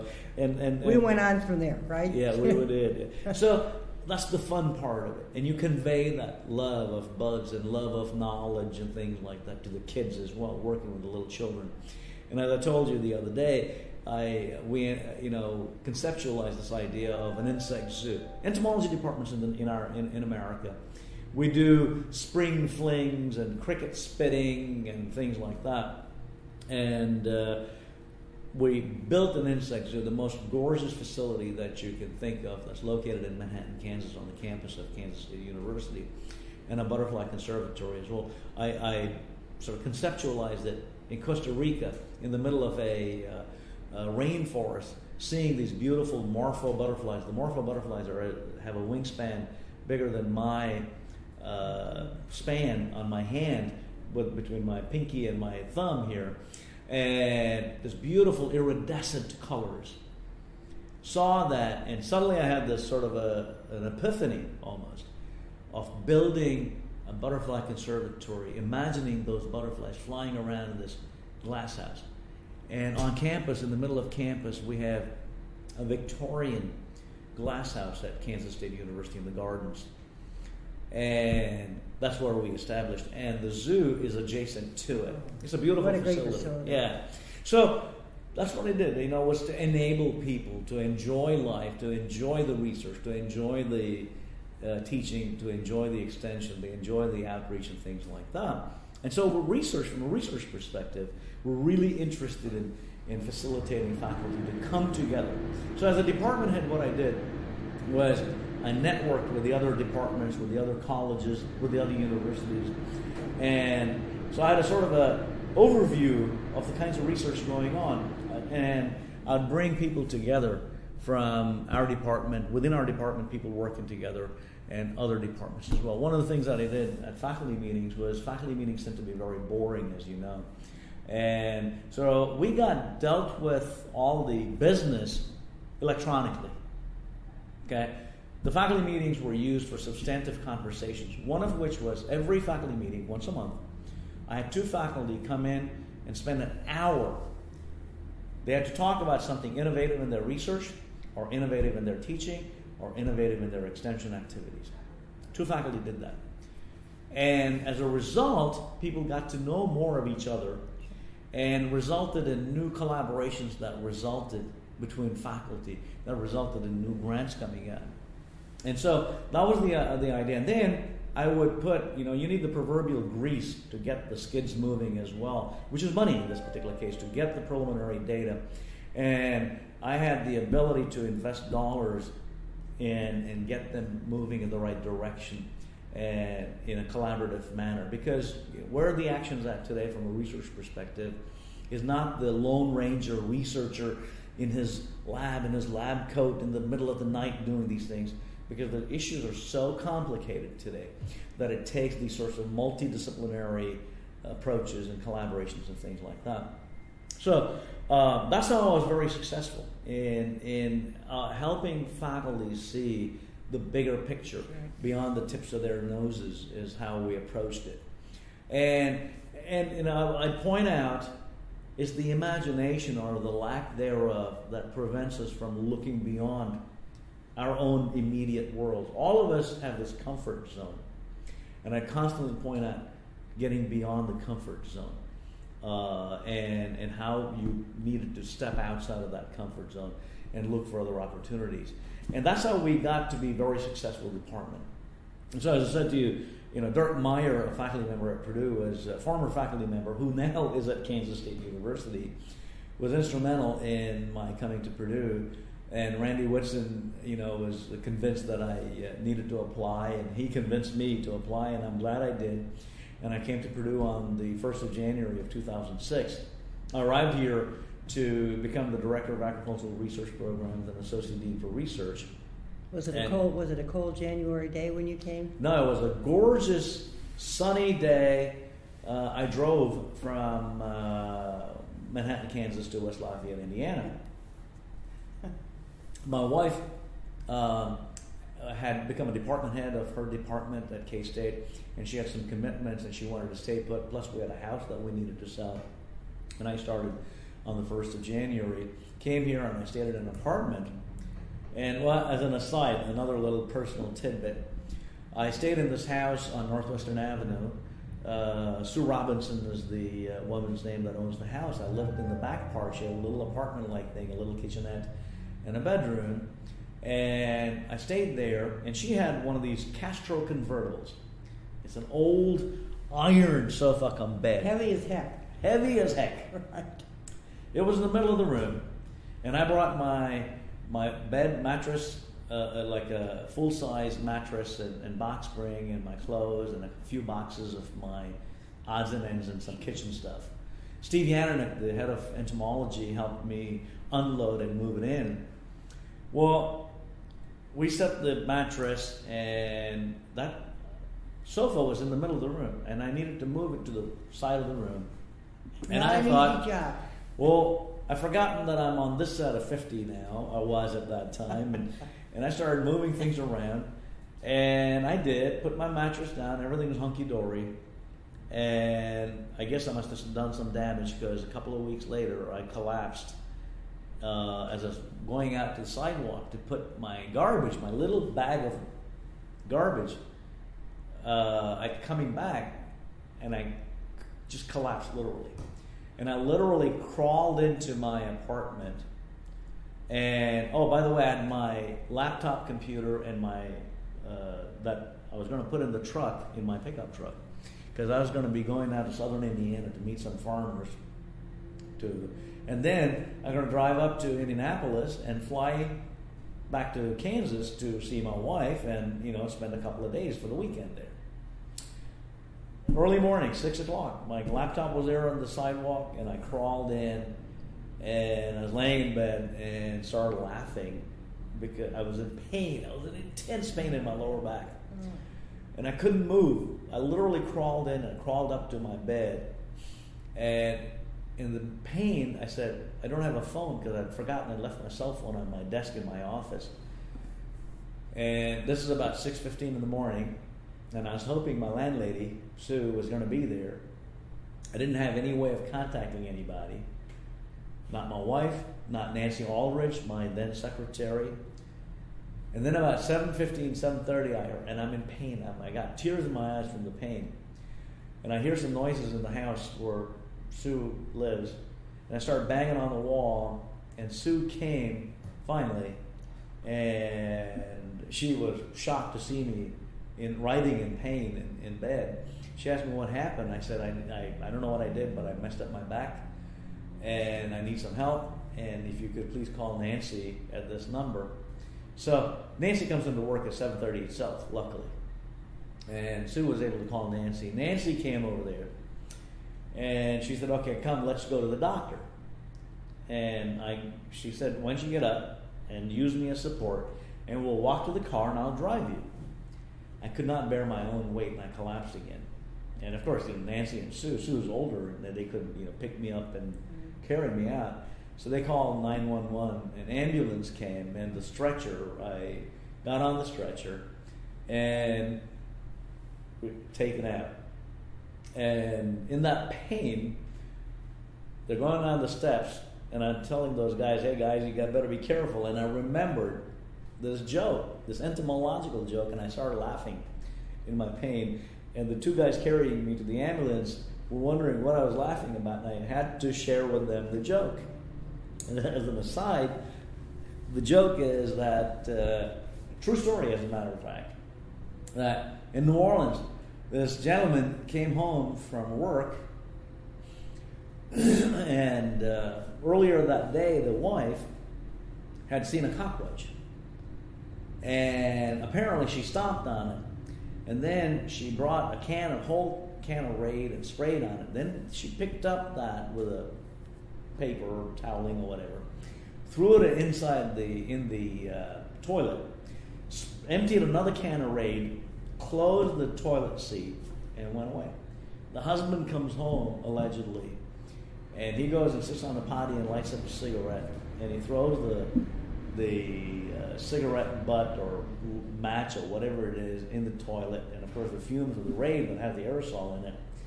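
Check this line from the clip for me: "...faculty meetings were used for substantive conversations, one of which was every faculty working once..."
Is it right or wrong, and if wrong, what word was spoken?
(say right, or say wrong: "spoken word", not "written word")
wrong: "meeting", not "working".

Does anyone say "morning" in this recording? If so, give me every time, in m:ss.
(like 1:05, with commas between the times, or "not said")
6:52, 7:19.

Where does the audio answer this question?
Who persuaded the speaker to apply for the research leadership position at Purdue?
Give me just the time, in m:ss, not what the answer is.
4:16.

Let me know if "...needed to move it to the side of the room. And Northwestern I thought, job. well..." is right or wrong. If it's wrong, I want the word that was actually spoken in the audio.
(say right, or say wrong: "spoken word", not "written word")
wrong: "Not", not "Northwestern".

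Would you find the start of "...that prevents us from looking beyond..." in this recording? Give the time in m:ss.
3:44.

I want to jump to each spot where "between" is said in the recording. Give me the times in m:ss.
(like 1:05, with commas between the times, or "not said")
0:54, 2:44.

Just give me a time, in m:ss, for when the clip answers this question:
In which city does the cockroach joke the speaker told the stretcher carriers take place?
9:05.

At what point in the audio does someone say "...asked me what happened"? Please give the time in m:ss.
7:52.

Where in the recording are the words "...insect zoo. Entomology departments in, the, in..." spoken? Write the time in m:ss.
0:17.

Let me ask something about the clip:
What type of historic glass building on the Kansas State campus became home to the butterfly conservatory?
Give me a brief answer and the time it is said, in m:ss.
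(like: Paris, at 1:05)
Victorian glass house, at 1:15.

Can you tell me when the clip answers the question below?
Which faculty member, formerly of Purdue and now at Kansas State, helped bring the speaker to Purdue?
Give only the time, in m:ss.
4:06.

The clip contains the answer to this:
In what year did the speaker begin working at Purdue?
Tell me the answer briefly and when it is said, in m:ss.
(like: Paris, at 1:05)
2006, at 4:25.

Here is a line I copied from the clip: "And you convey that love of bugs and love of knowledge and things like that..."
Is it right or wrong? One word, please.
right.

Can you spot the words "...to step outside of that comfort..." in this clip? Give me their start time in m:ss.
3:58.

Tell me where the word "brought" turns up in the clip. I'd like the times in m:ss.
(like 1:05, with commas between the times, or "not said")
5:29, 9:21.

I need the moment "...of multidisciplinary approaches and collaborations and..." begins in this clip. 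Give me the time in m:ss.
3:22.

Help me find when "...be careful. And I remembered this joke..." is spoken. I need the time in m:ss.
8:44.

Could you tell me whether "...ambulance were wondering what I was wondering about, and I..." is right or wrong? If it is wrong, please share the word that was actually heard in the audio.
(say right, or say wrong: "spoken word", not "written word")
wrong: "laughing", not "wondering".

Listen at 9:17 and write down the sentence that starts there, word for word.
And apparently, she stomped on it.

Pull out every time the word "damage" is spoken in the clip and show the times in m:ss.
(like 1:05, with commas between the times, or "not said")
6:10.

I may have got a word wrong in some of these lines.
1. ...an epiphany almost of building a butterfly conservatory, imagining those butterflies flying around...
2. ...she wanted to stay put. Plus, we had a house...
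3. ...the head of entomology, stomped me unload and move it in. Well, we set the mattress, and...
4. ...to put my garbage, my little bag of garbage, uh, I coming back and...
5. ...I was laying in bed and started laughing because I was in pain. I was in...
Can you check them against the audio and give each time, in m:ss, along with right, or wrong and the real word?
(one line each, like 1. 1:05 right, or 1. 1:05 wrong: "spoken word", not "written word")
1. 1:03 right
2. 4:52 right
3. 5:41 wrong: "helped", not "stomped"
4. 6:16 right
5. 6:58 right.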